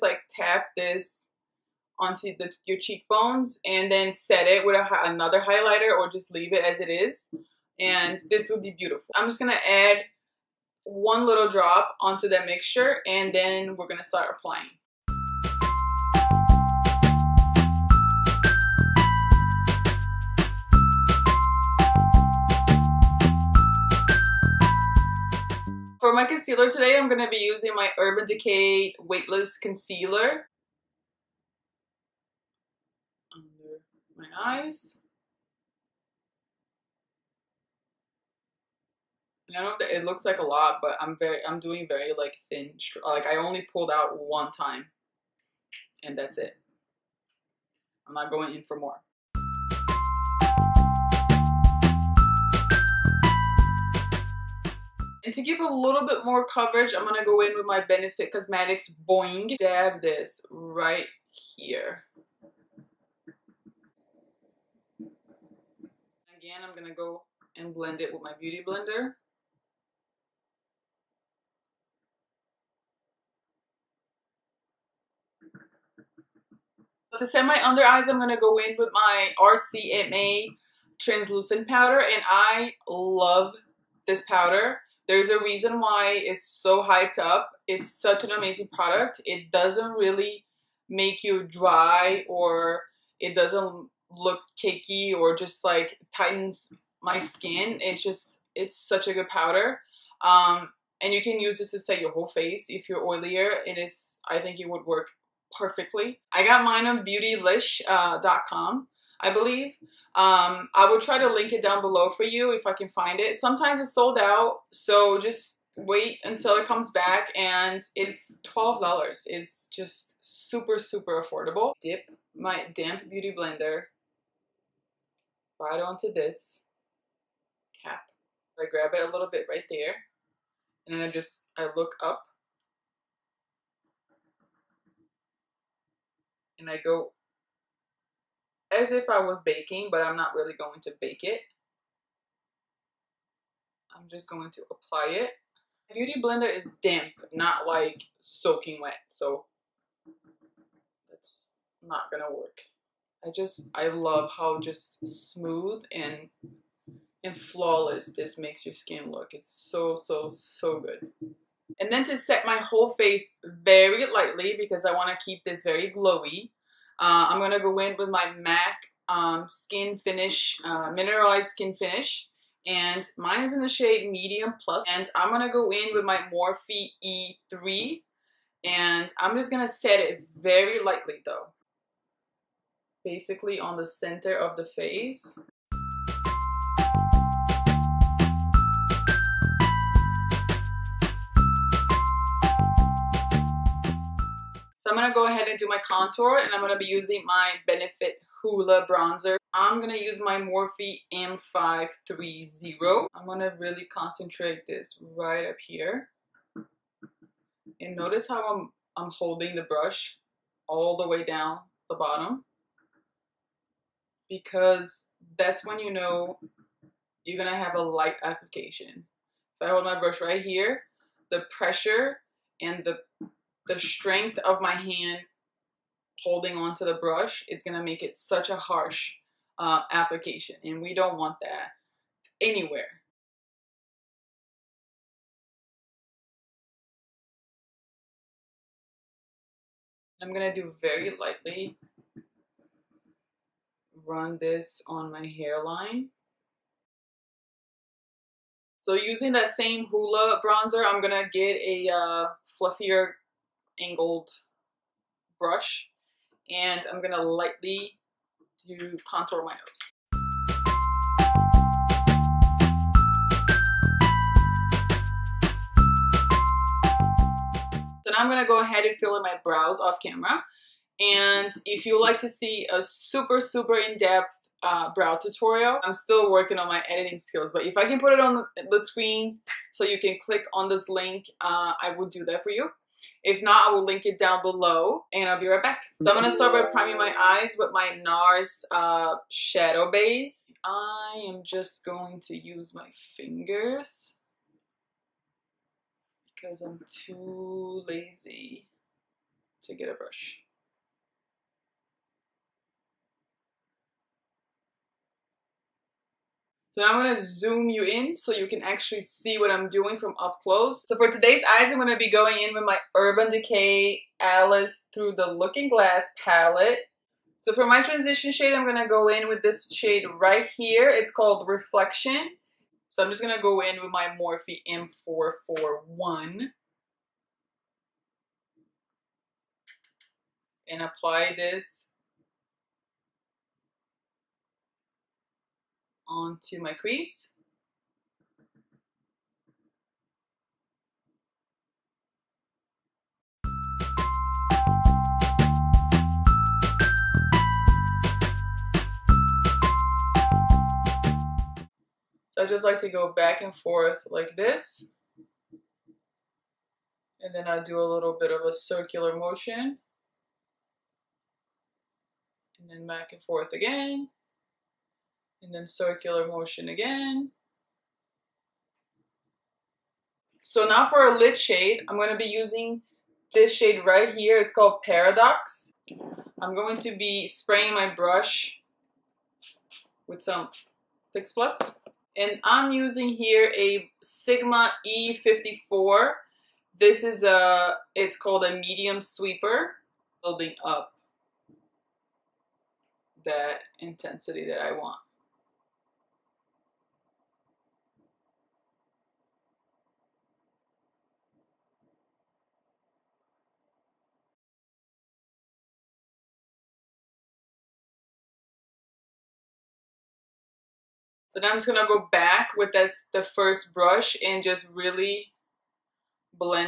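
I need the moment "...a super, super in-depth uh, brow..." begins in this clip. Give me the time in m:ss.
4:32.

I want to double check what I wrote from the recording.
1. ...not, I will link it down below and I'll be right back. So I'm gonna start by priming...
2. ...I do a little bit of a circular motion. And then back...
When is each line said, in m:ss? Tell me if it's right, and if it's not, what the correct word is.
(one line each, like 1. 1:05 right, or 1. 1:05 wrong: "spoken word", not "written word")
1. 4:43 right
2. 5:57 right.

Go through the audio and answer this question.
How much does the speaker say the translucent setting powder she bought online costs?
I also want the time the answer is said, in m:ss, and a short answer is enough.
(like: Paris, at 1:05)
$12, at 1:58.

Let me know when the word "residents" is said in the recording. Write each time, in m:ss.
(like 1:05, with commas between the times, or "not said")
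not said.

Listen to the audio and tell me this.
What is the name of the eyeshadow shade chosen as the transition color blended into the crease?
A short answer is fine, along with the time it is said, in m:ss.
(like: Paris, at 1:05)
Reflection, at 5:21.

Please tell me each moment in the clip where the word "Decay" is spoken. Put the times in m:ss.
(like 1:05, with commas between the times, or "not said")
0:28, 5:13.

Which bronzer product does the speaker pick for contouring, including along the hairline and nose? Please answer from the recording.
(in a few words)
Benefit Hoola.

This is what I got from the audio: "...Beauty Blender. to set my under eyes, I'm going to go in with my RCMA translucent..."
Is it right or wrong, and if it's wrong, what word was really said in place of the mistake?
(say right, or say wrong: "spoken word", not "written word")
right.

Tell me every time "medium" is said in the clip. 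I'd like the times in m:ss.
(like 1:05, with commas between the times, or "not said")
2:54, 6:28.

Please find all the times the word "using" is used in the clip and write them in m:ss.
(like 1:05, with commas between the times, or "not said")
0:27, 3:16, 4:08, 6:12, 6:22.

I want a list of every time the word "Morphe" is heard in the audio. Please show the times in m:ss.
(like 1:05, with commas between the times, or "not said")
2:56, 3:20, 5:24.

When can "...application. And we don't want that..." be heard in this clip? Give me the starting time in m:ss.
3:49.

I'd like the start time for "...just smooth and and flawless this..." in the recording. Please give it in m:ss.
2:34.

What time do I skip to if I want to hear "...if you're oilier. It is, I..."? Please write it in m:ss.
1:42.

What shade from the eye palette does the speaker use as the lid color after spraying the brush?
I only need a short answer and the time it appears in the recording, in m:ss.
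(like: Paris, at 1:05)
Paradox, at 6:14.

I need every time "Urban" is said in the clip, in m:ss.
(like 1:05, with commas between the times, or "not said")
0:27, 5:12.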